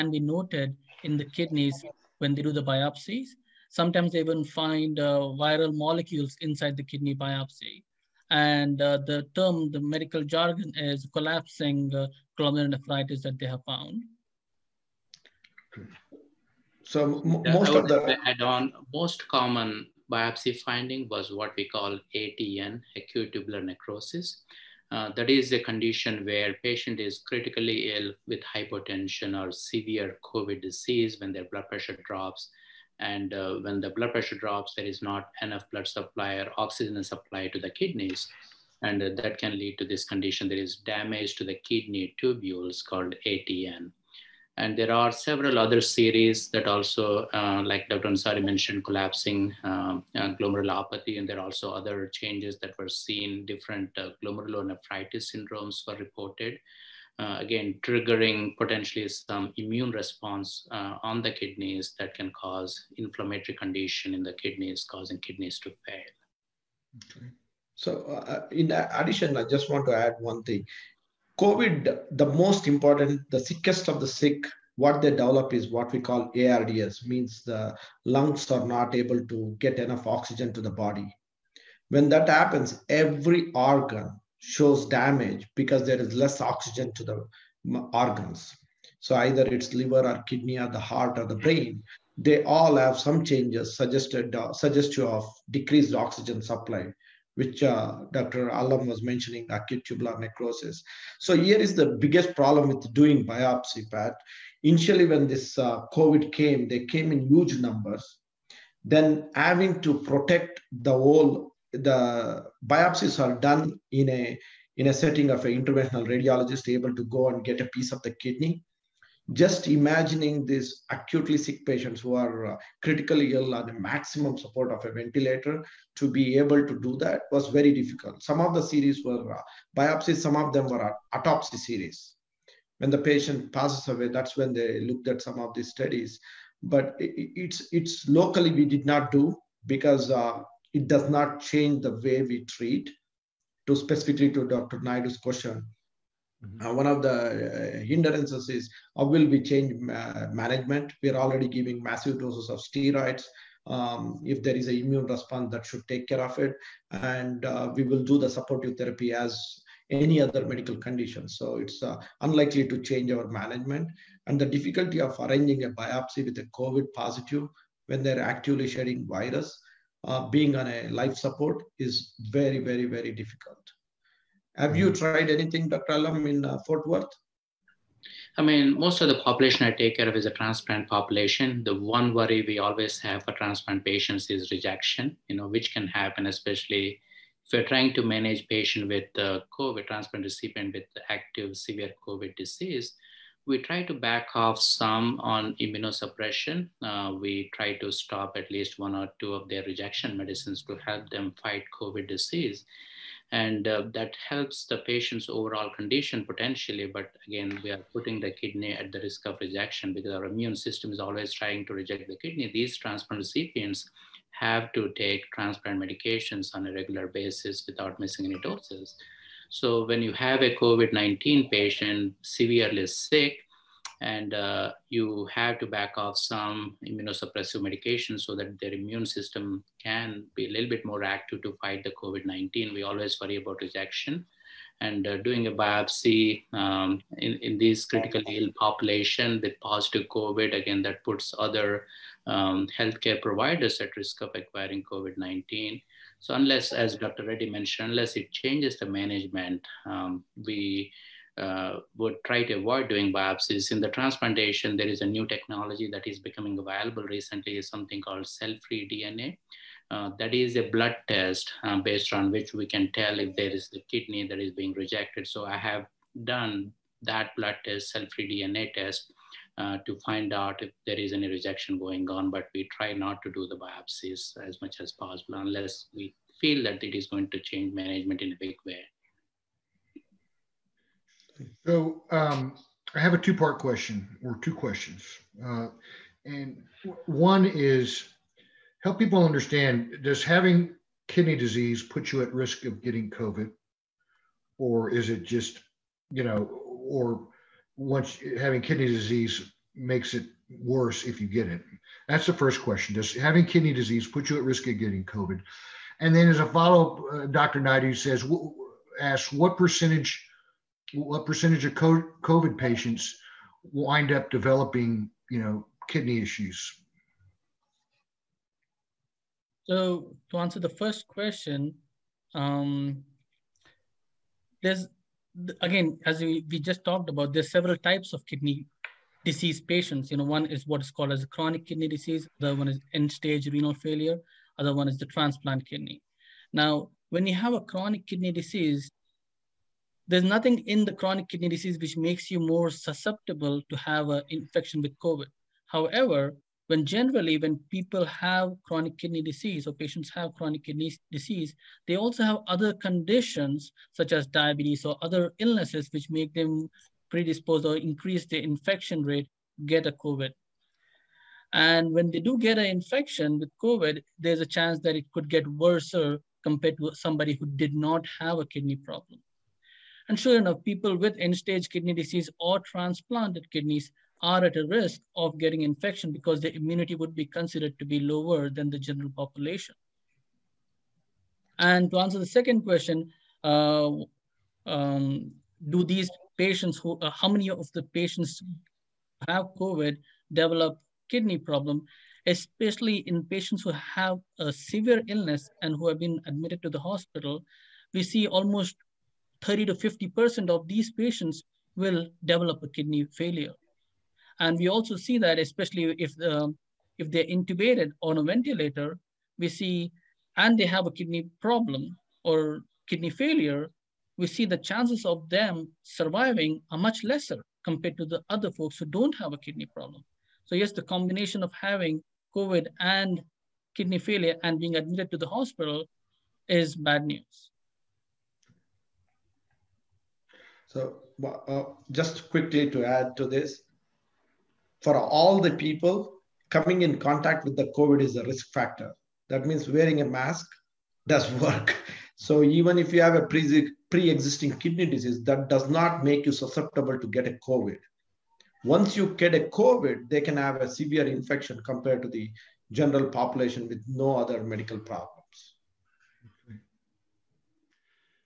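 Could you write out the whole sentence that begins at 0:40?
There is damage to the kidney tubules called ATN.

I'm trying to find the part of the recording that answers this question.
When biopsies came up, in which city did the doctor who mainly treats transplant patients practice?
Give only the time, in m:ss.
2:56.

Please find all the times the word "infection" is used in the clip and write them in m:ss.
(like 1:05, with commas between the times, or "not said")
5:44, 5:58, 6:02, 6:15, 7:31.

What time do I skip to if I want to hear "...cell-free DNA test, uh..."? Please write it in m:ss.
4:27.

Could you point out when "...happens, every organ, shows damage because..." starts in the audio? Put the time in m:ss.
1:22.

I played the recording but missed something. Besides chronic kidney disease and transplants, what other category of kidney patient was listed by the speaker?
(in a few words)
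end-stage renal failure.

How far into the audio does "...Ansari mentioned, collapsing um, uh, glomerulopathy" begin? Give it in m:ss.
0:48.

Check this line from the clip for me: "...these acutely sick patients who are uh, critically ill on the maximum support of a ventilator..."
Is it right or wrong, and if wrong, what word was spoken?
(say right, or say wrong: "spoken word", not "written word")
right.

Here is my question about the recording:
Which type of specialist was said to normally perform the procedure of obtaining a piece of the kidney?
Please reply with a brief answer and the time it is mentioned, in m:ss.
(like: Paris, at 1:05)
interventional radiologist, at 1:55.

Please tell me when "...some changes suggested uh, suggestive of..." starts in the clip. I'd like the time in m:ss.
1:32.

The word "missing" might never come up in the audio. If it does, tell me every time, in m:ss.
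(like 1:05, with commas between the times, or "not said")
3:37.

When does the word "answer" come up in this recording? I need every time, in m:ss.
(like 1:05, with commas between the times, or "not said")
5:20, 6:21.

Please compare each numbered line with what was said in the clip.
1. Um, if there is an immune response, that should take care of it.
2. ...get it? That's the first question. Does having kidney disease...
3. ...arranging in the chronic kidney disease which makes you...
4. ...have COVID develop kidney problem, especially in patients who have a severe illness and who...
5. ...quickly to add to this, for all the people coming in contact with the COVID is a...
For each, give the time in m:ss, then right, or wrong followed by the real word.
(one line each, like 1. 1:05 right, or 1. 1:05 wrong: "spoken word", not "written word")
1. 2:33 right
2. 5:01 right
3. 5:40 wrong: "nothing", not "arranging"
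4. 6:29 right
5. 7:12 right.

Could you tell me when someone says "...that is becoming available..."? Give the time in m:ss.
4:15.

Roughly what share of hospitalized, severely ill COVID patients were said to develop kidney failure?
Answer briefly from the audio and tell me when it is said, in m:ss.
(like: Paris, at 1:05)
30 to 50%, at 6:39.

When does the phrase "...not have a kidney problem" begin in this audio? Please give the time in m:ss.
6:07.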